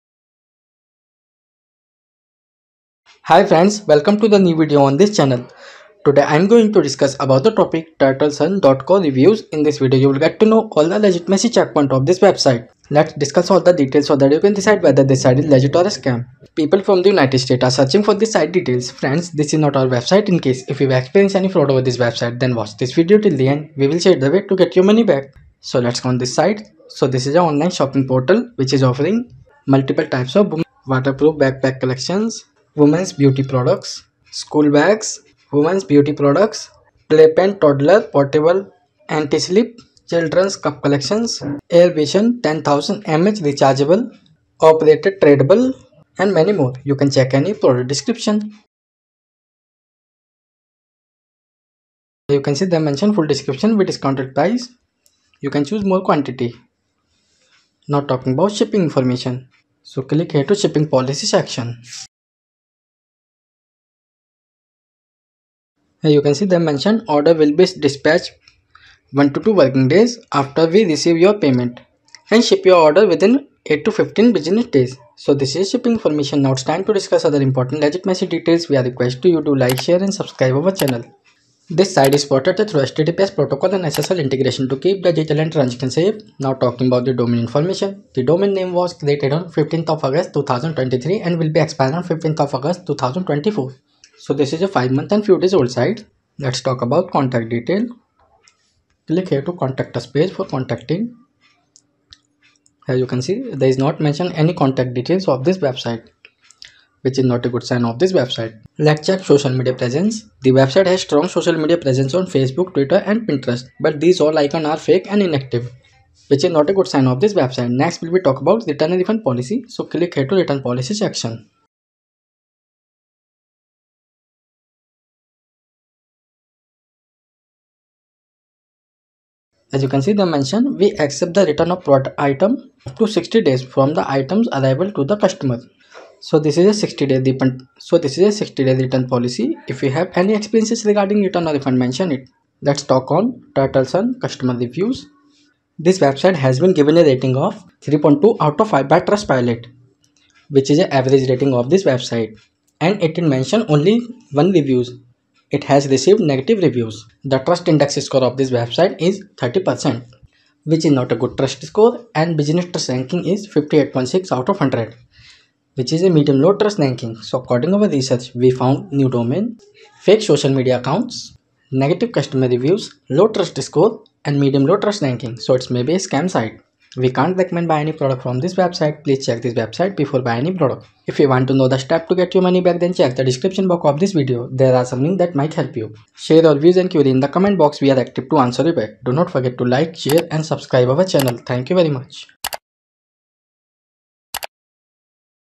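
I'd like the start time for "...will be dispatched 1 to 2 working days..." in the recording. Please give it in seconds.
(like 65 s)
67 s.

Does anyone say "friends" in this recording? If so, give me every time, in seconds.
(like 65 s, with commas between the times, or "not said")
3 s, 18 s.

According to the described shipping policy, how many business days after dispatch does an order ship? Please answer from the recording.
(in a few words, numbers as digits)
8 to 15.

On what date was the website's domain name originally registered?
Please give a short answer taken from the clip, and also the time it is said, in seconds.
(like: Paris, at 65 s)
15 August 2023, at 89 s.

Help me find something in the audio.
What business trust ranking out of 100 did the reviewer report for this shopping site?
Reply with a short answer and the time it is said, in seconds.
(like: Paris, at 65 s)
58.6, at 163 s.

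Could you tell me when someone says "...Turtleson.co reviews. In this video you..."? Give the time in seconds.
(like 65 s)
7 s.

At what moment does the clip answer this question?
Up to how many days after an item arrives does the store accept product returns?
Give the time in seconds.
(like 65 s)
133 s.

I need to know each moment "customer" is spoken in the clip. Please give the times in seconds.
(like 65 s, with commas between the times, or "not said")
135 s, 144 s, 172 s.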